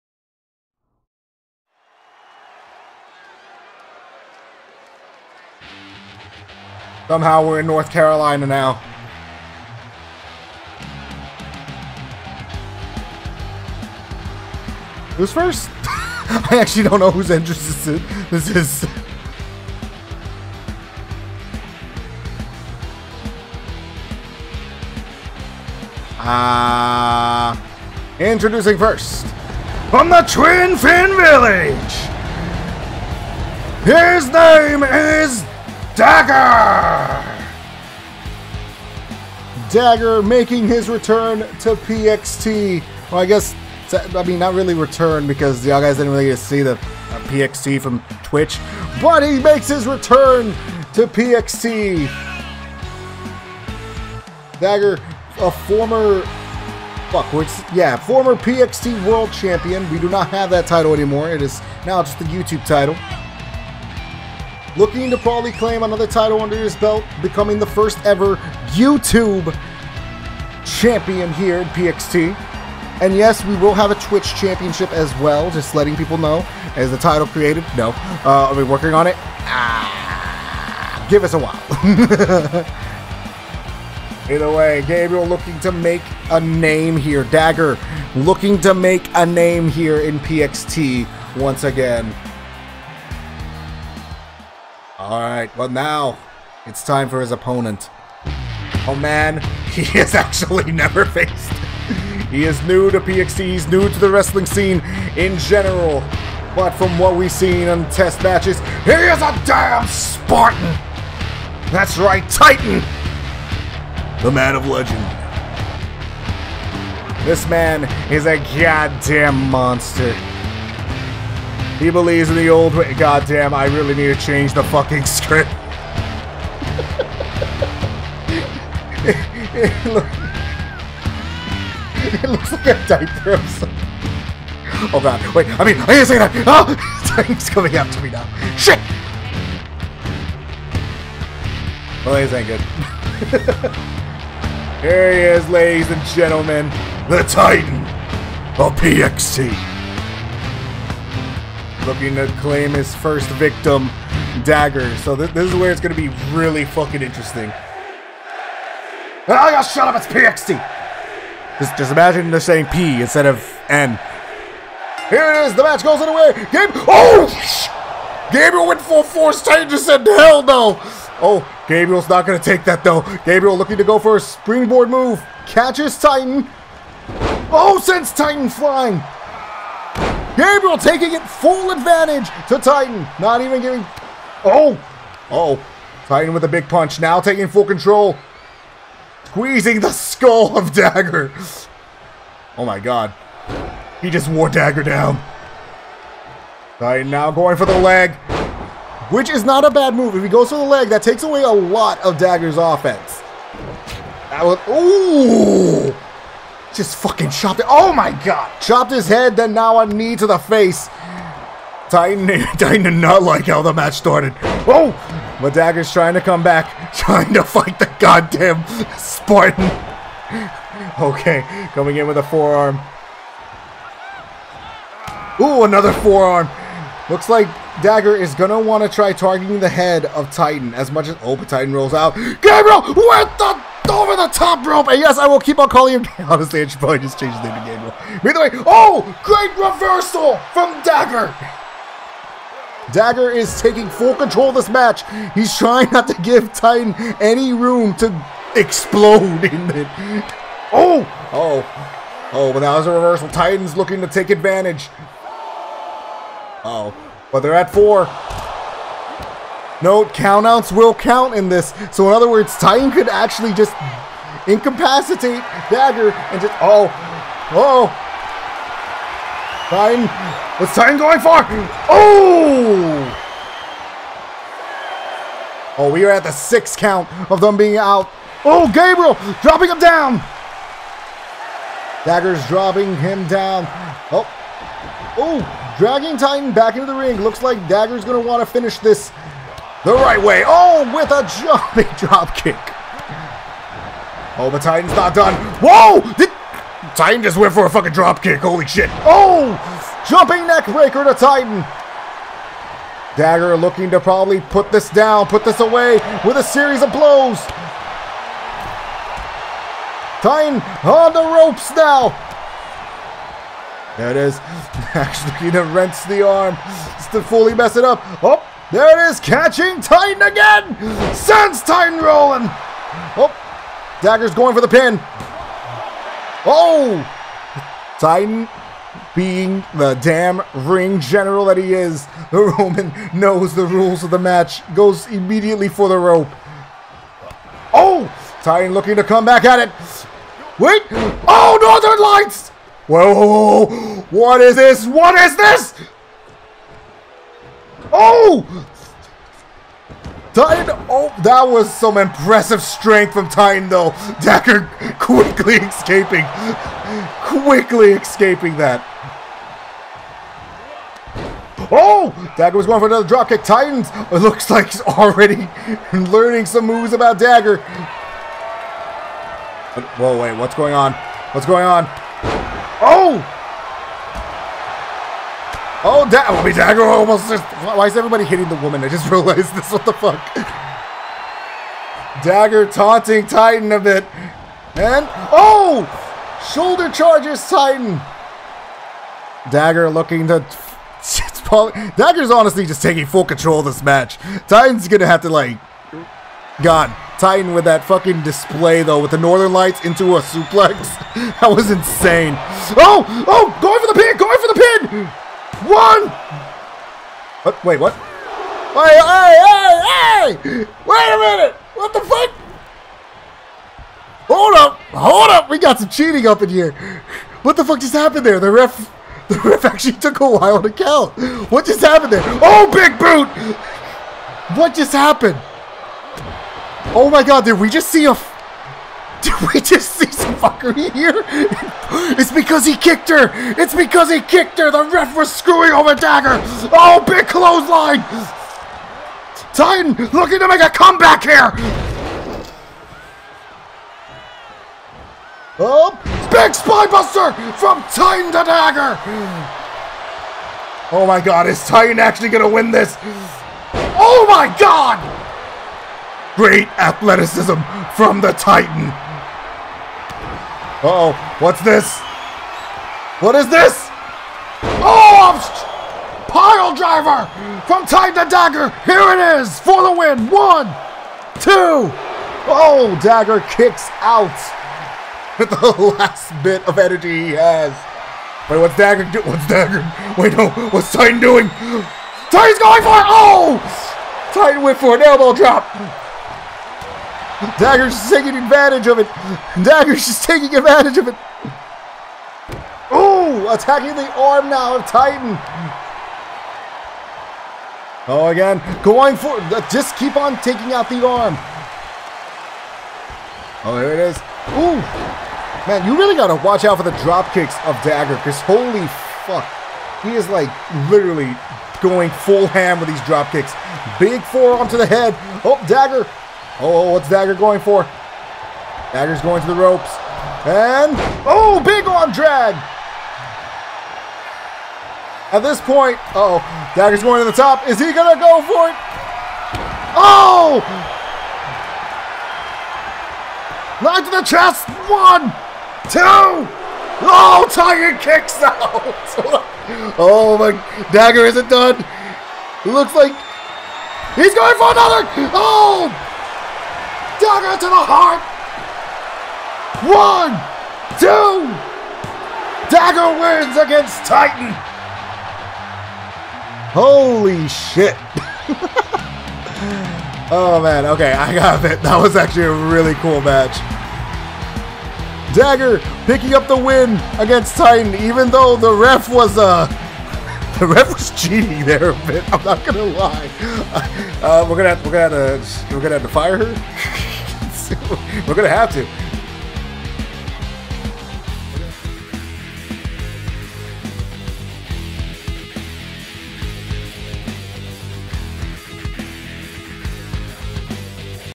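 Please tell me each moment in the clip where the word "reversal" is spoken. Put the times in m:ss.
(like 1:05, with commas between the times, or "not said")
3:59, 4:12.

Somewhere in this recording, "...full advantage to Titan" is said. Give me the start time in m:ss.
3:01.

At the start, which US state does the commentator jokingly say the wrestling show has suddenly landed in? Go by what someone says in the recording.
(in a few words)
North Carolina.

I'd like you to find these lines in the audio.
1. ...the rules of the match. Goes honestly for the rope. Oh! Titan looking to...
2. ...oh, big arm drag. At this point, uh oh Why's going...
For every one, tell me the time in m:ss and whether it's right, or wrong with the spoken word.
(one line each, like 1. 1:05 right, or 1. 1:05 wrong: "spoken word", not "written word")
1. 5:33 wrong: "immediately", not "honestly"
2. 8:41 wrong: "Dagger", not "Why".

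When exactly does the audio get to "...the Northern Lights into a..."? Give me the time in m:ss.
6:39.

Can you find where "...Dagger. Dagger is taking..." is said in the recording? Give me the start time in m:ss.
4:00.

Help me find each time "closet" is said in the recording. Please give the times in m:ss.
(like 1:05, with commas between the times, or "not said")
not said.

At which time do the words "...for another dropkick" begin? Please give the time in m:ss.
6:02.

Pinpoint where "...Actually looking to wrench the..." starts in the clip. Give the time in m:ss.
5:14.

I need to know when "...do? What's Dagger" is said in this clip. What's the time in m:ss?
7:59.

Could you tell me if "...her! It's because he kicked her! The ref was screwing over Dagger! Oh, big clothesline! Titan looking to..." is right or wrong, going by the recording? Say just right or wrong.
right.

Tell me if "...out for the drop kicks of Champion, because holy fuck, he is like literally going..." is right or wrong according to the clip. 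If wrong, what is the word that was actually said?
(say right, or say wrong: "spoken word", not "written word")
wrong: "Dagger", not "Champion".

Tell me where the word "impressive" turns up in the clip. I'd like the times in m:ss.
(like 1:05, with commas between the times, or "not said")
5:51.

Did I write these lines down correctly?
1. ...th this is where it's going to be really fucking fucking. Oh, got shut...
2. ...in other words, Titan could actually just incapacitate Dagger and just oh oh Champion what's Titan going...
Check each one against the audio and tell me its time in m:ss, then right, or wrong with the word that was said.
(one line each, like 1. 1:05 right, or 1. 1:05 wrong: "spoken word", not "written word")
1. 2:35 wrong: "interesting", not "fucking"
2. 4:22 wrong: "Titan", not "Champion".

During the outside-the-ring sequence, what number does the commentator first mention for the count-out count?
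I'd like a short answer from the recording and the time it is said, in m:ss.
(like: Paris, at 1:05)
4, at 4:17.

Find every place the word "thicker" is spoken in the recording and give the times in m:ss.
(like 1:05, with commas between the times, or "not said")
not said.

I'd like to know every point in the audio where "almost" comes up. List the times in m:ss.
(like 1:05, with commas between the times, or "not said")
6:16.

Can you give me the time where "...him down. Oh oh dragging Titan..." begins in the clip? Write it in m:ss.
4:42.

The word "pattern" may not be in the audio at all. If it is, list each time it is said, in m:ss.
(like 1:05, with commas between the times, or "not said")
not said.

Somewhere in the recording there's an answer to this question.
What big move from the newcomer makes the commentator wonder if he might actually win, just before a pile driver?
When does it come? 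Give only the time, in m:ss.
7:26.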